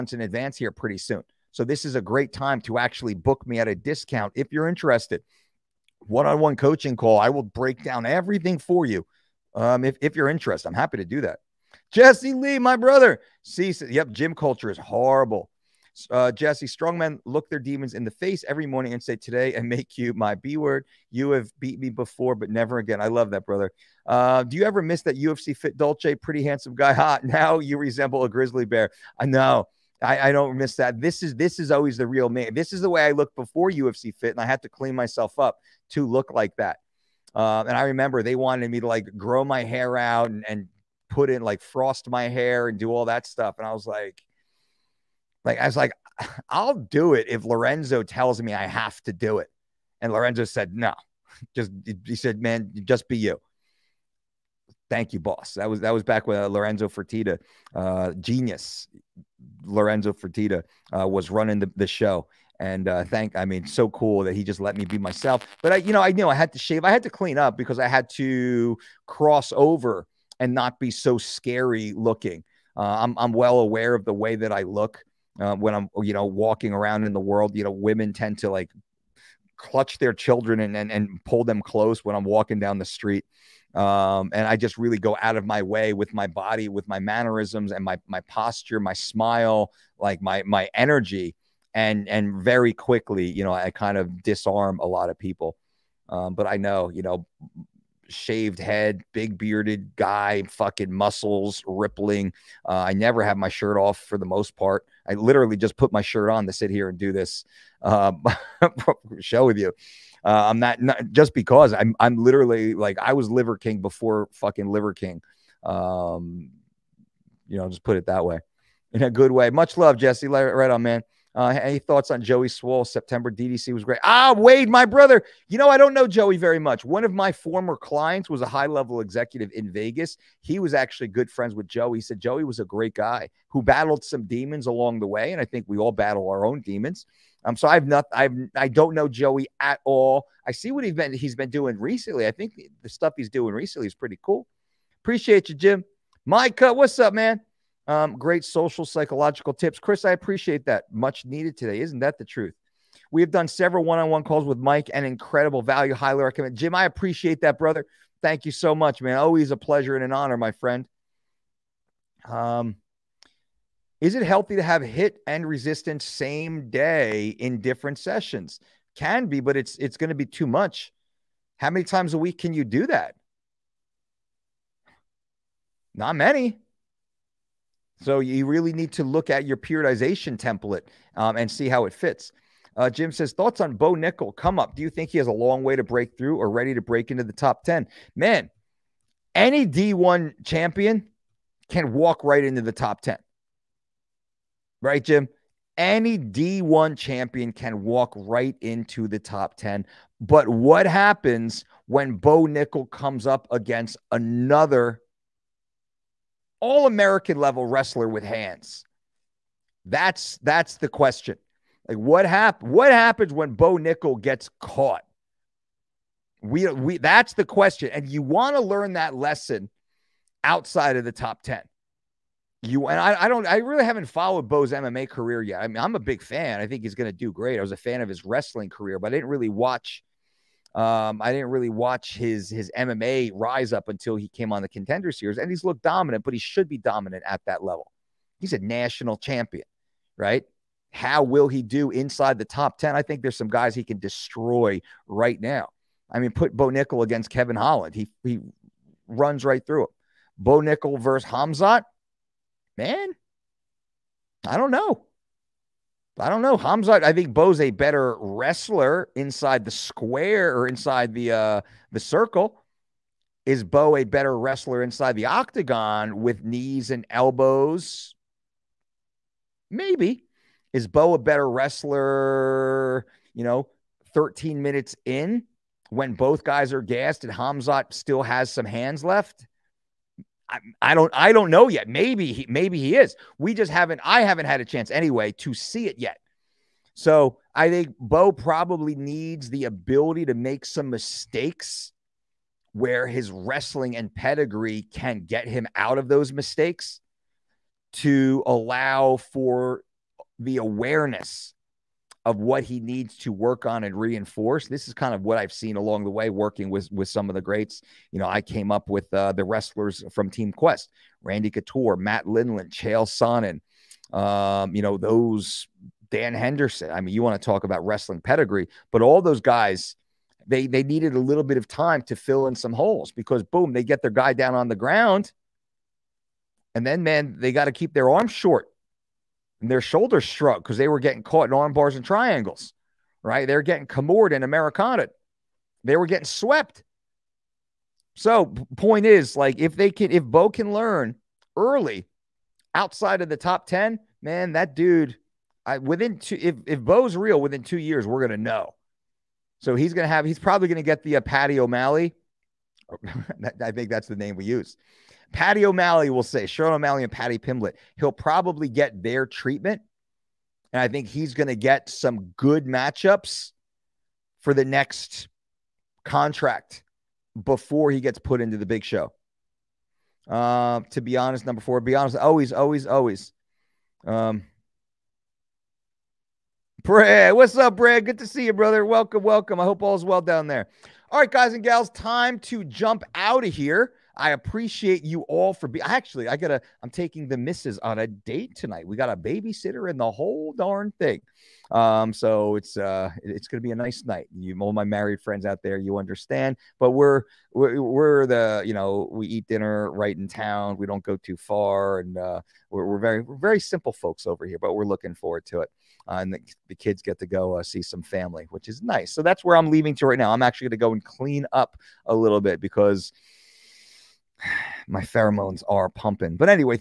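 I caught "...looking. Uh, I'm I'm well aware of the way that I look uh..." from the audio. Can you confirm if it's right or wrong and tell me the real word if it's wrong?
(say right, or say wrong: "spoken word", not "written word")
right.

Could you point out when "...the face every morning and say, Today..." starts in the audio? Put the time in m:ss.
0:18.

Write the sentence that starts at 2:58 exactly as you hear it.
So you really need to look at your periodization template um, and see how it fits.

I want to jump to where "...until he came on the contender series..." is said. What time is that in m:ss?
3:53.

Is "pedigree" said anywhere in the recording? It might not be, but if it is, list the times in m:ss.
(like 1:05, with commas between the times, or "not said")
4:54, 5:18.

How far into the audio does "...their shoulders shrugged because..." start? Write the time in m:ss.
5:29.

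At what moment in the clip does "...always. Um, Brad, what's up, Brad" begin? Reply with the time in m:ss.
6:12.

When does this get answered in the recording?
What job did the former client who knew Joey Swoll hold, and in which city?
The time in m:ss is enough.
2:08.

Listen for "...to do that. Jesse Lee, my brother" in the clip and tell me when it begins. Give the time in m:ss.
0:10.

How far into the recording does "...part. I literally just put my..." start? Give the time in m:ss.
1:44.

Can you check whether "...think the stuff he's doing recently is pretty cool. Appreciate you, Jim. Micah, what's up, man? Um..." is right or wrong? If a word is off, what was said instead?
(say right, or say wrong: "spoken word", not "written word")
right.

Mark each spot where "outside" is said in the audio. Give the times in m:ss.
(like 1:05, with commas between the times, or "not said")
3:40, 5:42.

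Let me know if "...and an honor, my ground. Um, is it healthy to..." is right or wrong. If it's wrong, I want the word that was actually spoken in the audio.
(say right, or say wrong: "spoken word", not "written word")
wrong: "friend", not "ground".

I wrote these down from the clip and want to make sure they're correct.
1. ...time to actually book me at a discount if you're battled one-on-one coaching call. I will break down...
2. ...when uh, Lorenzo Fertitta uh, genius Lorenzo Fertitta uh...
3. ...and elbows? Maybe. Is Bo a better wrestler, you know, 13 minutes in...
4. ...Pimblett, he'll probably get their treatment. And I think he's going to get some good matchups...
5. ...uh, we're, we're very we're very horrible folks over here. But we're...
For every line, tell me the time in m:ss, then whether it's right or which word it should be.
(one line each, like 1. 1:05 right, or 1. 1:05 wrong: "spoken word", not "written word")
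1. 0:02 wrong: "interested", not "battled"
2. 0:56 right
3. 4:26 right
4. 5:57 right
5. 6:42 wrong: "simple", not "horrible".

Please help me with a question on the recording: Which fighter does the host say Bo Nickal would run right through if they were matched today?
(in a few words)
Kevin Holland.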